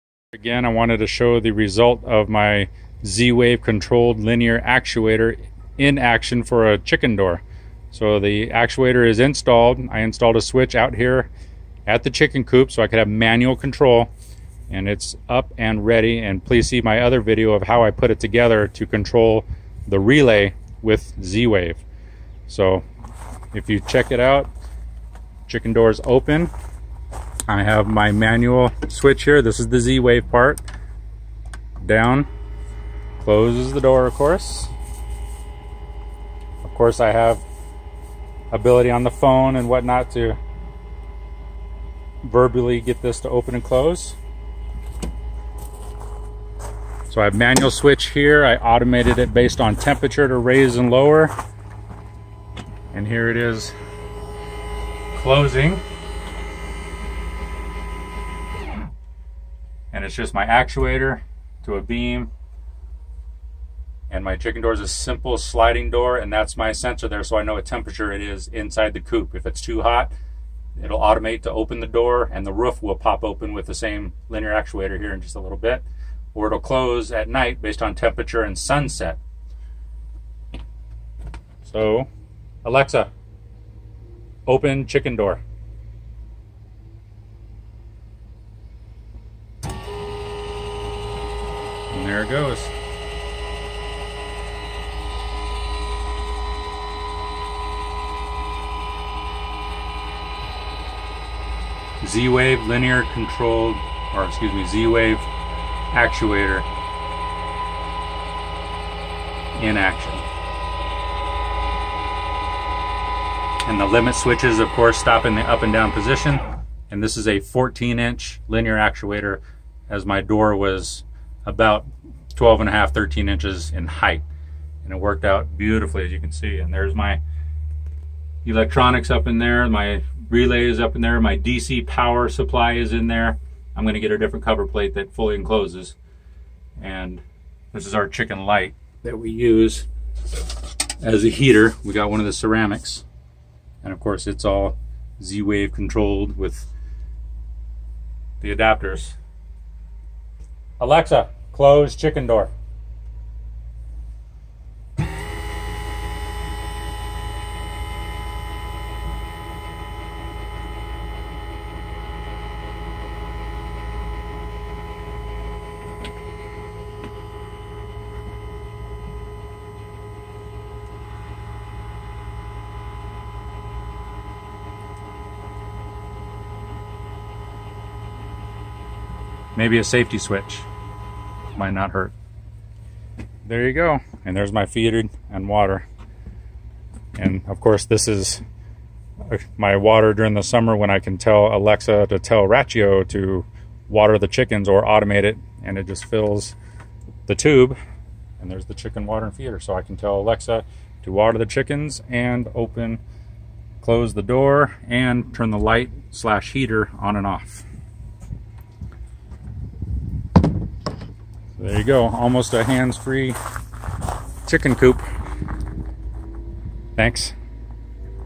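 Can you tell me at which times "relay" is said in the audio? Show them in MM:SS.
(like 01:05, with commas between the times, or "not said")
00:19, 02:10.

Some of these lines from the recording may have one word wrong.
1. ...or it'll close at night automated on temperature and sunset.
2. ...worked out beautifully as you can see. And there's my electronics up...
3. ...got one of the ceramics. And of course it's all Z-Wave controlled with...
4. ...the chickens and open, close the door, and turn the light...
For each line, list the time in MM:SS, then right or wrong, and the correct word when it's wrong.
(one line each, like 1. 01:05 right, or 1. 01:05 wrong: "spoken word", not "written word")
1. 01:16 wrong: "based", not "automated"
2. 02:04 right
3. 02:21 right
4. 03:21 right.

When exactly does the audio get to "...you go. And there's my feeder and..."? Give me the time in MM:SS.
03:03.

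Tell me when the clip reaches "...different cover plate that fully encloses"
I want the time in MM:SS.
02:14.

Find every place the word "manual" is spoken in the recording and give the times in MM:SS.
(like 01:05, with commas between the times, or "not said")
00:13, 00:28, 00:47.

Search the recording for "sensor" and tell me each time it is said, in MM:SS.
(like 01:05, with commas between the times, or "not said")
01:06.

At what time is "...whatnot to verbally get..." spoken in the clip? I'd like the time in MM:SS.
00:39.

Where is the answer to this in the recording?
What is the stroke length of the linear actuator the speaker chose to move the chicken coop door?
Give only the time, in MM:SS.
01:57.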